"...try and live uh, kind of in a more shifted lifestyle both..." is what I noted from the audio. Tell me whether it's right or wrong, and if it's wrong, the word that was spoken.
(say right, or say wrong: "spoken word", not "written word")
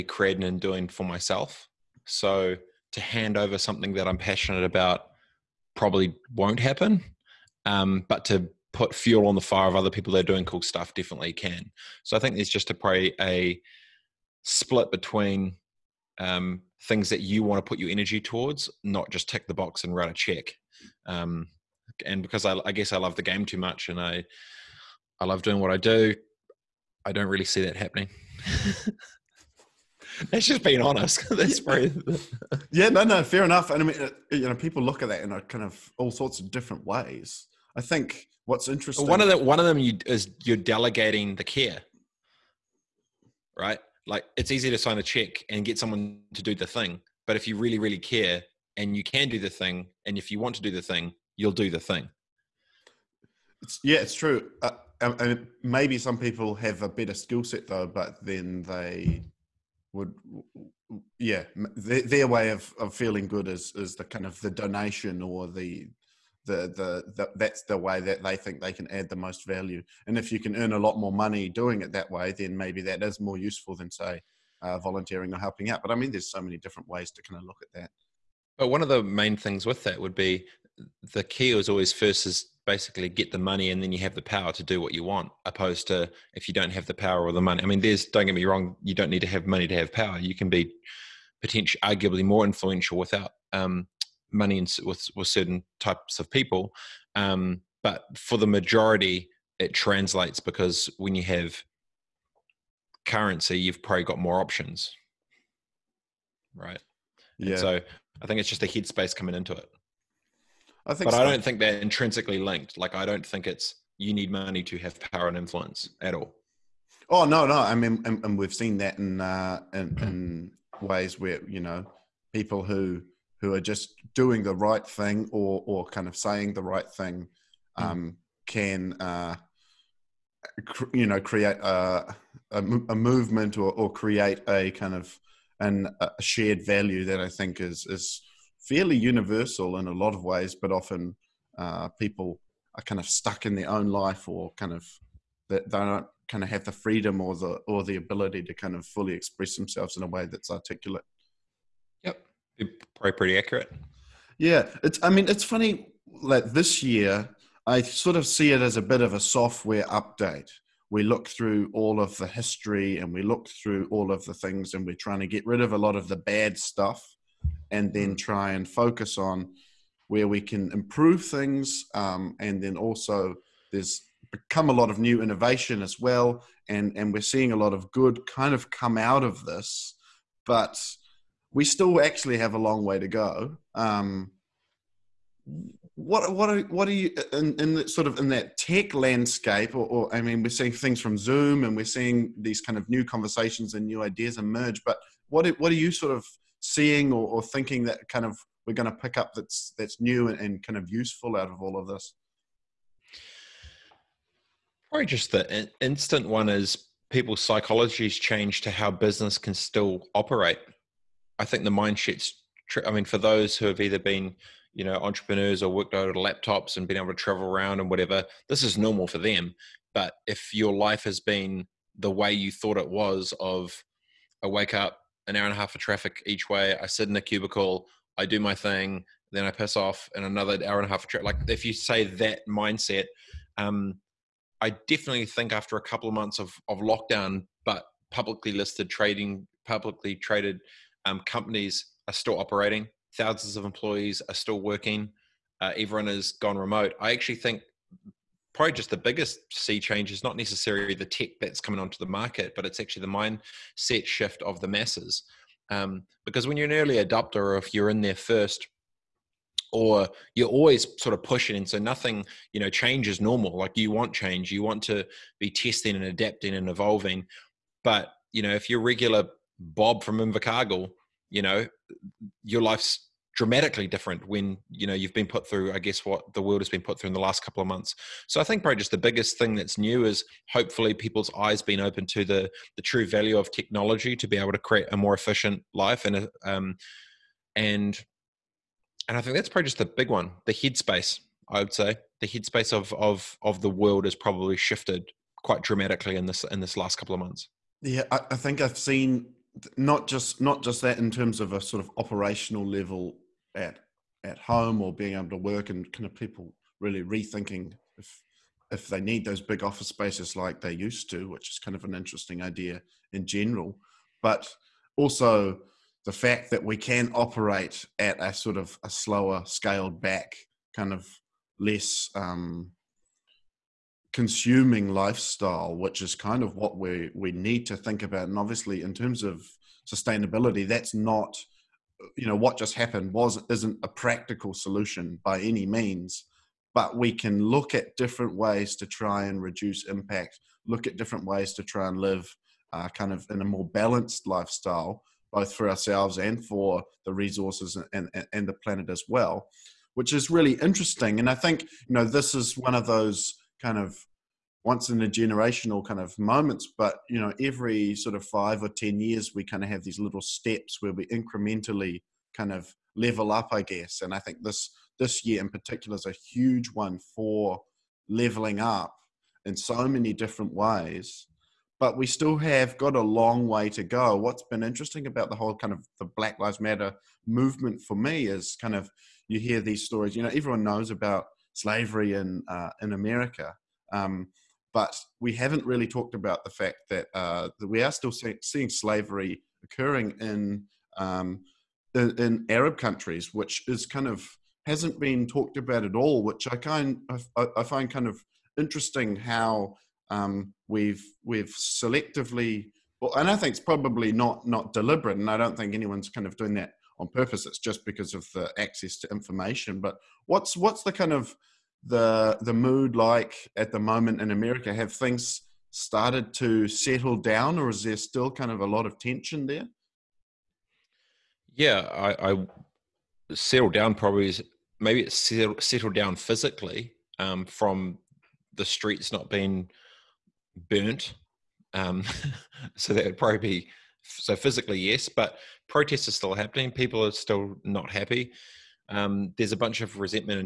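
wrong: "balanced", not "shifted".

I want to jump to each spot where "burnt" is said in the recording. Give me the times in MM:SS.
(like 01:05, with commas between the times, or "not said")
07:10.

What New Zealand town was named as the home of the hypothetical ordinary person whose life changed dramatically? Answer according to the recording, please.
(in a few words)
Invercargill.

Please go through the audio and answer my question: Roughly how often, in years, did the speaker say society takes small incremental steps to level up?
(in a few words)
5 or 10 years.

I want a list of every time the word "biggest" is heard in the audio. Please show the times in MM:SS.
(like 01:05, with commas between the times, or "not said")
04:08, 04:38.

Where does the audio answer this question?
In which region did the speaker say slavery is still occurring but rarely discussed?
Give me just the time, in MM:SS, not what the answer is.
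06:32.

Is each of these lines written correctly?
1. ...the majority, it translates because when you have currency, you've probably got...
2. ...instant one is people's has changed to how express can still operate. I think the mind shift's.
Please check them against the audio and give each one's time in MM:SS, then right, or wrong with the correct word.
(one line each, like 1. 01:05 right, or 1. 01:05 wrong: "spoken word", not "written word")
1. 01:38 right
2. 03:25 wrong: "business", not "express".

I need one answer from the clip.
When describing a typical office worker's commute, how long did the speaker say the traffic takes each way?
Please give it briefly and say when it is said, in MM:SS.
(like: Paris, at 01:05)
an hour and a half, at 03:45.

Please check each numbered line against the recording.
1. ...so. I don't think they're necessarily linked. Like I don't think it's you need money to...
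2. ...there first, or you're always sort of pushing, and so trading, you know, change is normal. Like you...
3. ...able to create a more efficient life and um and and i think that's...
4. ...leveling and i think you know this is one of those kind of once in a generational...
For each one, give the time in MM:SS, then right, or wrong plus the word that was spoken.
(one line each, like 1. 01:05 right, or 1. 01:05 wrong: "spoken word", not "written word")
1. 01:51 wrong: "intrinsically", not "necessarily"
2. 04:18 wrong: "nothing", not "trading"
3. 04:44 right
4. 05:50 wrong: "interesting", not "leveling".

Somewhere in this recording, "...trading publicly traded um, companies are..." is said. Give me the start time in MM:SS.
03:58.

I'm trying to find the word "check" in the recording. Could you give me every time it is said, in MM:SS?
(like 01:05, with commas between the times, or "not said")
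00:20, 00:45.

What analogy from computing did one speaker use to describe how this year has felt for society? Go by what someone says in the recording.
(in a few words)
a software update.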